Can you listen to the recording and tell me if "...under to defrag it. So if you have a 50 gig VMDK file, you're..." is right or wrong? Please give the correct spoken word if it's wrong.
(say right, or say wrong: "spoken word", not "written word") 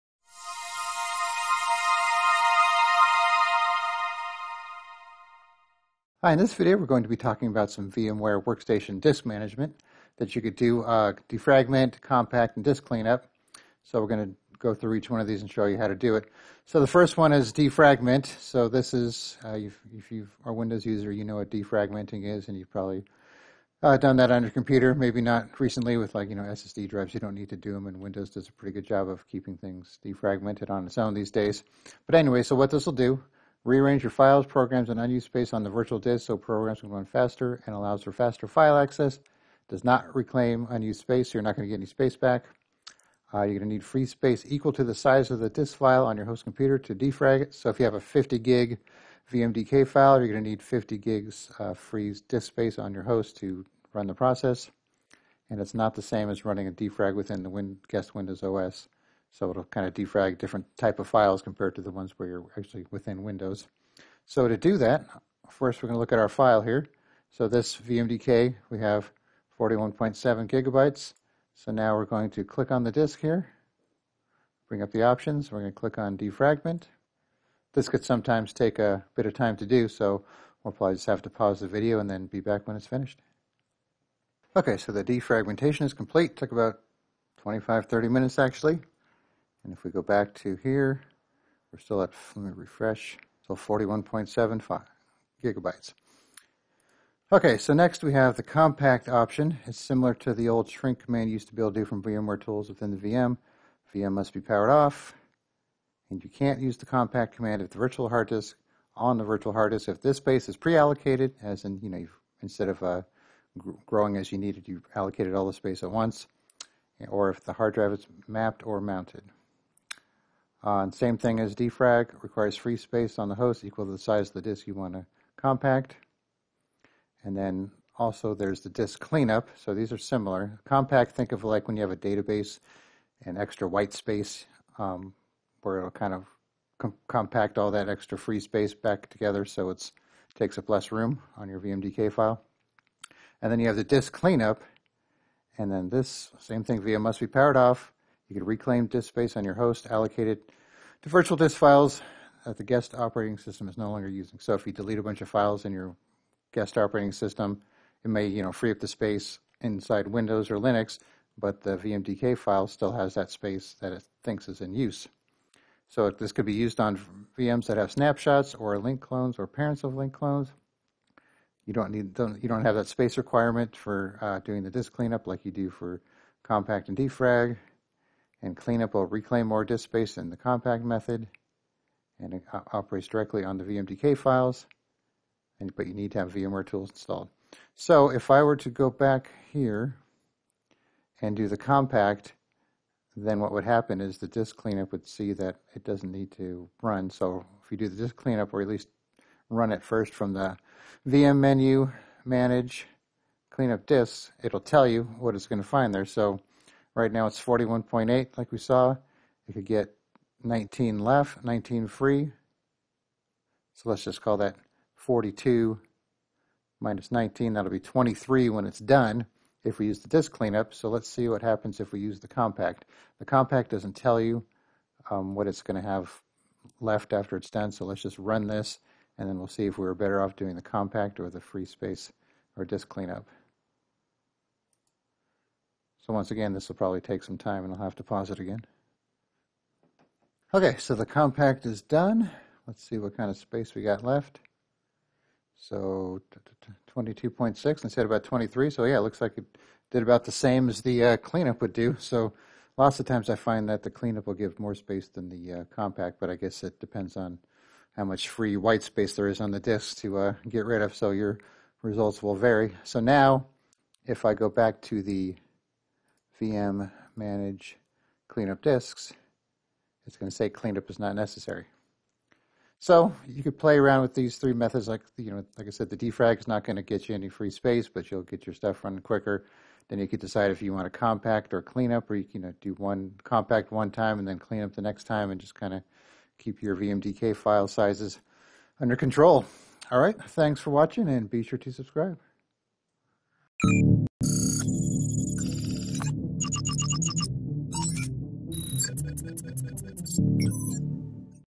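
wrong: "computer", not "under".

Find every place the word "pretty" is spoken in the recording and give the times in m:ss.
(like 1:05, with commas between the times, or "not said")
0:28.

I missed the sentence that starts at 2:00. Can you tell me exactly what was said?
Uh, same thing as defrag, requires free space on the host equal to the size of the disk you want to compact.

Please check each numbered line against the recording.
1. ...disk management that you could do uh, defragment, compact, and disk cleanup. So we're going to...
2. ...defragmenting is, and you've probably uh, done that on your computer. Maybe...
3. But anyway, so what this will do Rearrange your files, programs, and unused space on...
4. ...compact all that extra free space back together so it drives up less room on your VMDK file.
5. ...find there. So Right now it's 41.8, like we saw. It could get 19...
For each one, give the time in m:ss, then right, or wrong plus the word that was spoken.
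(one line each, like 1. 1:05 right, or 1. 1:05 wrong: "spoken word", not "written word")
1. 0:09 right
2. 0:21 right
3. 0:32 right
4. 2:17 wrong: "takes", not "drives"
5. 3:25 right.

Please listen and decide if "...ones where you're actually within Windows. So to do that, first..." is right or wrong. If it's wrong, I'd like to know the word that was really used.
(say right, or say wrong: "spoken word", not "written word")
right.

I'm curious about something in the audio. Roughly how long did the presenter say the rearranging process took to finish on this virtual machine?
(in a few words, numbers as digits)
25 to 30 minutes.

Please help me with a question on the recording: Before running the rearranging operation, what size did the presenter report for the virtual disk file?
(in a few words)
41.7 gigabytes.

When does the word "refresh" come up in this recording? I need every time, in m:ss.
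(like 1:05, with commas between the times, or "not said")
1:32.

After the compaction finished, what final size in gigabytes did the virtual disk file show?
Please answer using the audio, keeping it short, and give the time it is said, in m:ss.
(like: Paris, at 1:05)
22.6, at 4:06.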